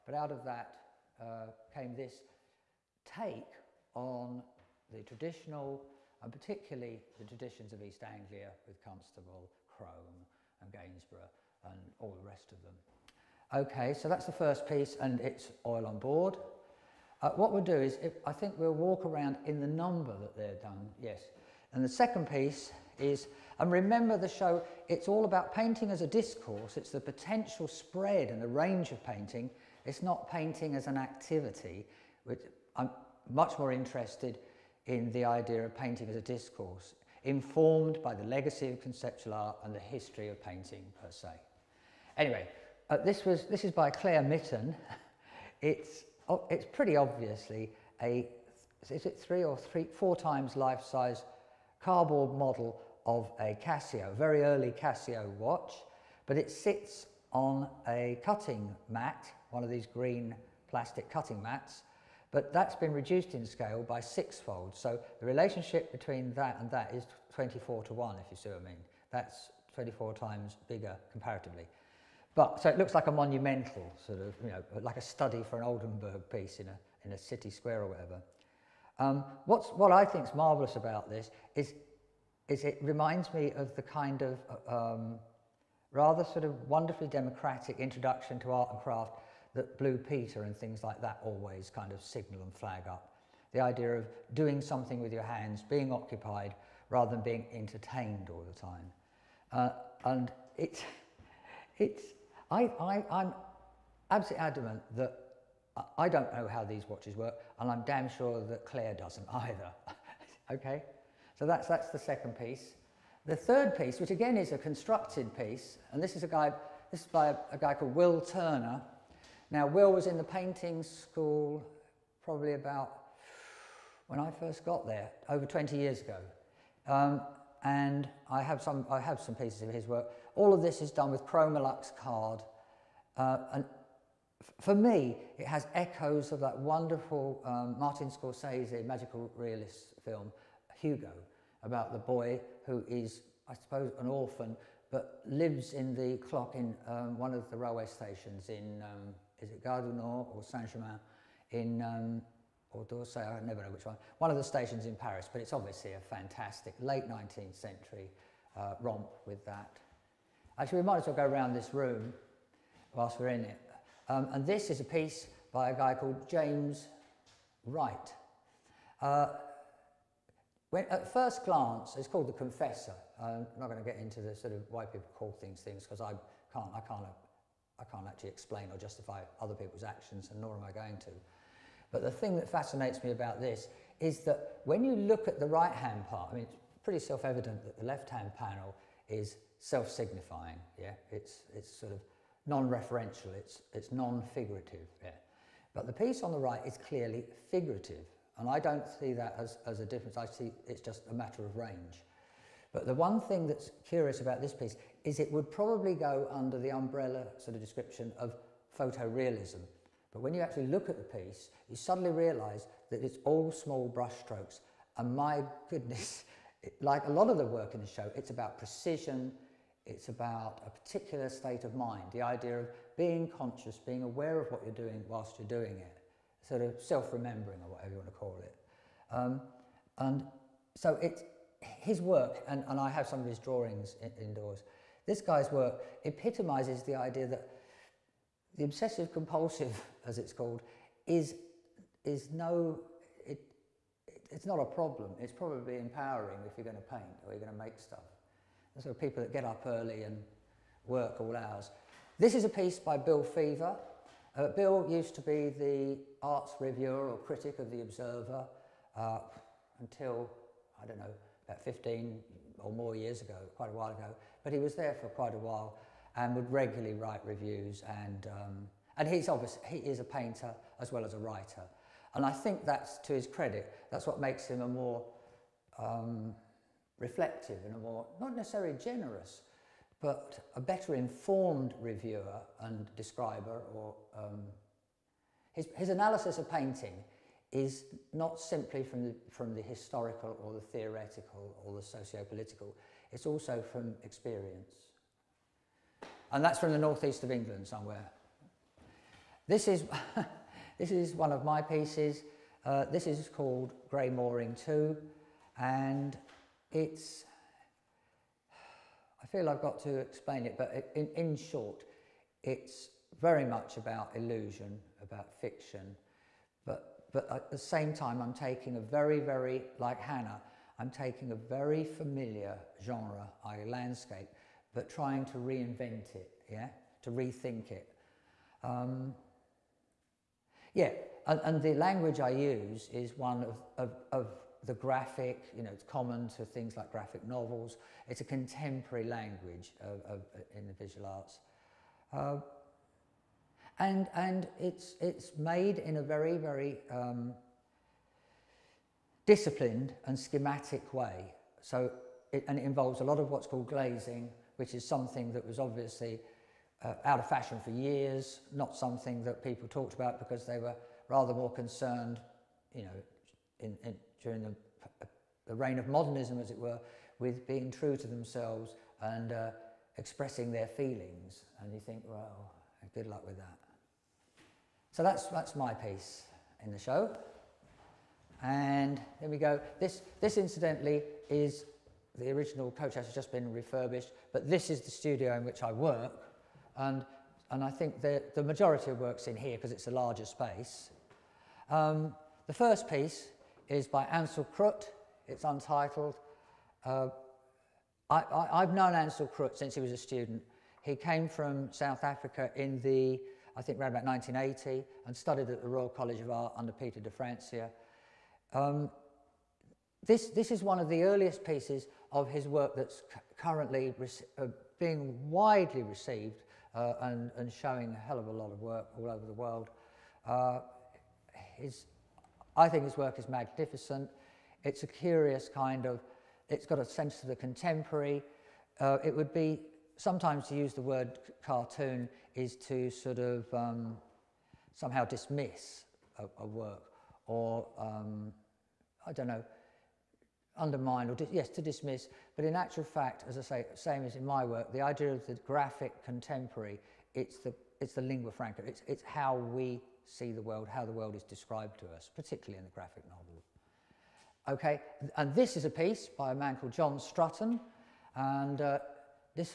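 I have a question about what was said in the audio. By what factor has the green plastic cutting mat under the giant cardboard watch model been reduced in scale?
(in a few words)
6.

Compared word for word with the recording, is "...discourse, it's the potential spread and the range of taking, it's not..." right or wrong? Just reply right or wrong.
wrong.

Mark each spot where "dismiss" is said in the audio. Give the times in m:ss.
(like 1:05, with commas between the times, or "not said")
7:15, 7:21.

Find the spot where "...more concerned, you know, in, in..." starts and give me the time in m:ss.
6:01.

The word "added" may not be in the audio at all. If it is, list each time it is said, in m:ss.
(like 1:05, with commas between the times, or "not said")
not said.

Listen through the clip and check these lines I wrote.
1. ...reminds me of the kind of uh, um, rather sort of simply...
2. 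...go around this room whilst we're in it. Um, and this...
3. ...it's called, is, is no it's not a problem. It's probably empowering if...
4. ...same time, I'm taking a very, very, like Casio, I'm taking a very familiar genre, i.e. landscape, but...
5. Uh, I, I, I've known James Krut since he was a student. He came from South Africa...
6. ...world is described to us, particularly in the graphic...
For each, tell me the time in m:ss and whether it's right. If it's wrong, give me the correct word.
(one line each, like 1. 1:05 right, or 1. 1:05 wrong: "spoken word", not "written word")
1. 1:22 wrong: "wonderfully", not "simply"
2. 2:41 right
3. 4:00 right
4. 5:17 wrong: "Hannah", not "Casio"
5. 6:36 wrong: "Ansel", not "James"
6. 7:30 right.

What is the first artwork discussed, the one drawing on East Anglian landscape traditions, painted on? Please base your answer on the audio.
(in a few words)
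Oil on board.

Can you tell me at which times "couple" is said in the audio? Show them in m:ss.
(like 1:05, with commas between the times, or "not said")
not said.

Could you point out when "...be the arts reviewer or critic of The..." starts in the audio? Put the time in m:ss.
4:15.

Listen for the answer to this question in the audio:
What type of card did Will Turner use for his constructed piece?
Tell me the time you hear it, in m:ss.
2:11.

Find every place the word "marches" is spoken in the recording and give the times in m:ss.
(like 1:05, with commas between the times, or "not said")
not said.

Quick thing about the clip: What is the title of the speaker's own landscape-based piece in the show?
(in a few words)
Grey Mooring 2.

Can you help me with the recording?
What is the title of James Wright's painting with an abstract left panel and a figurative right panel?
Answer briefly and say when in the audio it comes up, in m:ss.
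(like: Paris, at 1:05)
The Confessor, at 2:52.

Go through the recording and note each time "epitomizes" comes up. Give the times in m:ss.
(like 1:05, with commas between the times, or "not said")
3:56.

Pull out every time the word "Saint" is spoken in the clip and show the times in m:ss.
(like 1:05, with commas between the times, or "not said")
2:30.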